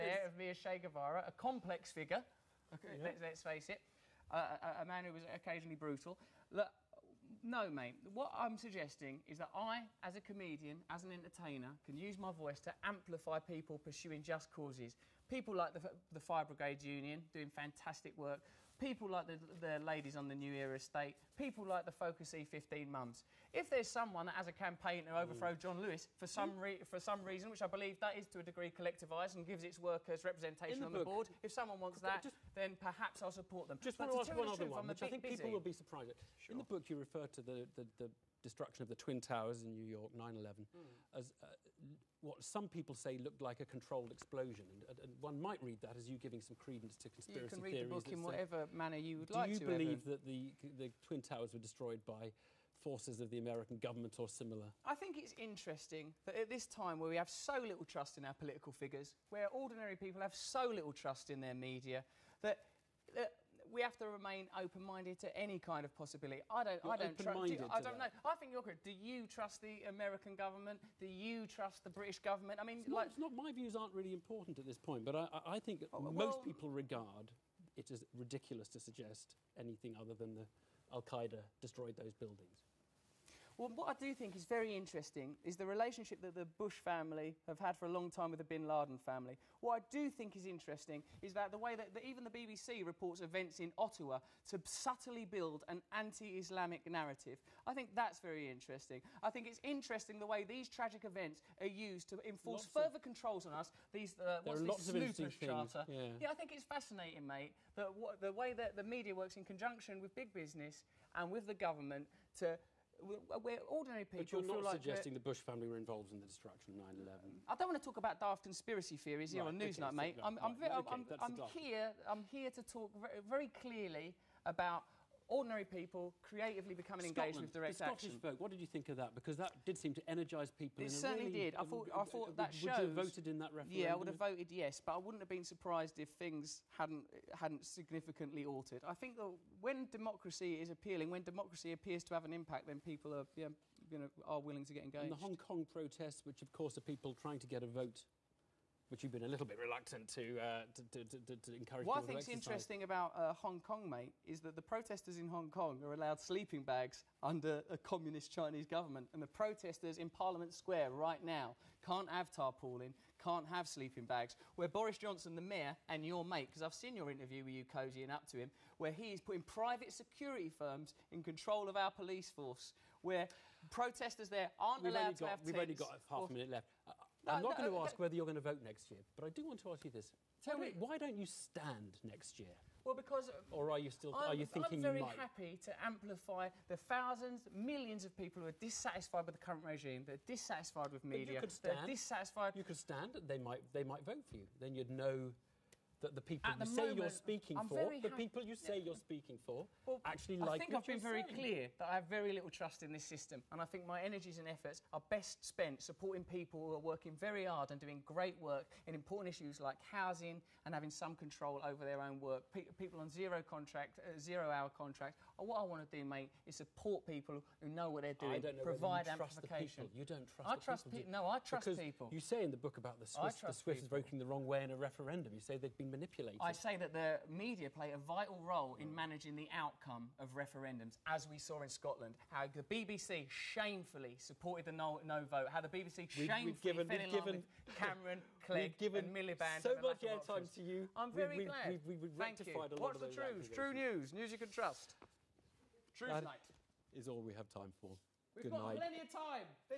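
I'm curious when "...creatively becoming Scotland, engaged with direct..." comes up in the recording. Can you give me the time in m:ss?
2:06.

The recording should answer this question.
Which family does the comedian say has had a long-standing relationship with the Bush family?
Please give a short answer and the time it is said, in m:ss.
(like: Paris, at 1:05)
Bin Laden family, at 1:28.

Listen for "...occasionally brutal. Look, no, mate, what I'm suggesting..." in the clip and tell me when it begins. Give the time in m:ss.
0:05.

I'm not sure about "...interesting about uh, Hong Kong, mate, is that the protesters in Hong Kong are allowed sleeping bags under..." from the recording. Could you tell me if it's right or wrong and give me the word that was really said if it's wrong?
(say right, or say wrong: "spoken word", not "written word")
right.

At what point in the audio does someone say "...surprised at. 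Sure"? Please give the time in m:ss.
0:35.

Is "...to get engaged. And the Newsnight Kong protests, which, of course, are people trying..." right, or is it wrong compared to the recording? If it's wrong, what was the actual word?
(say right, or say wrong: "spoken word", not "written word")
wrong: "Hong", not "Newsnight".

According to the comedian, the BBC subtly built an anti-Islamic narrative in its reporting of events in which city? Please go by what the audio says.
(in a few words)
Ottawa.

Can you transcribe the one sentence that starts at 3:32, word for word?
people on zero contract, uh, zero hour contract.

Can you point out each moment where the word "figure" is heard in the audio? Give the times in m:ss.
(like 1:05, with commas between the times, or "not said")
0:01, 0:58.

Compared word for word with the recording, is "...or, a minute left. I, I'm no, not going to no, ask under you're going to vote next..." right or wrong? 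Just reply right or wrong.
wrong.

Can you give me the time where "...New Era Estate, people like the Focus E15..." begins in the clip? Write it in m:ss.
0:20.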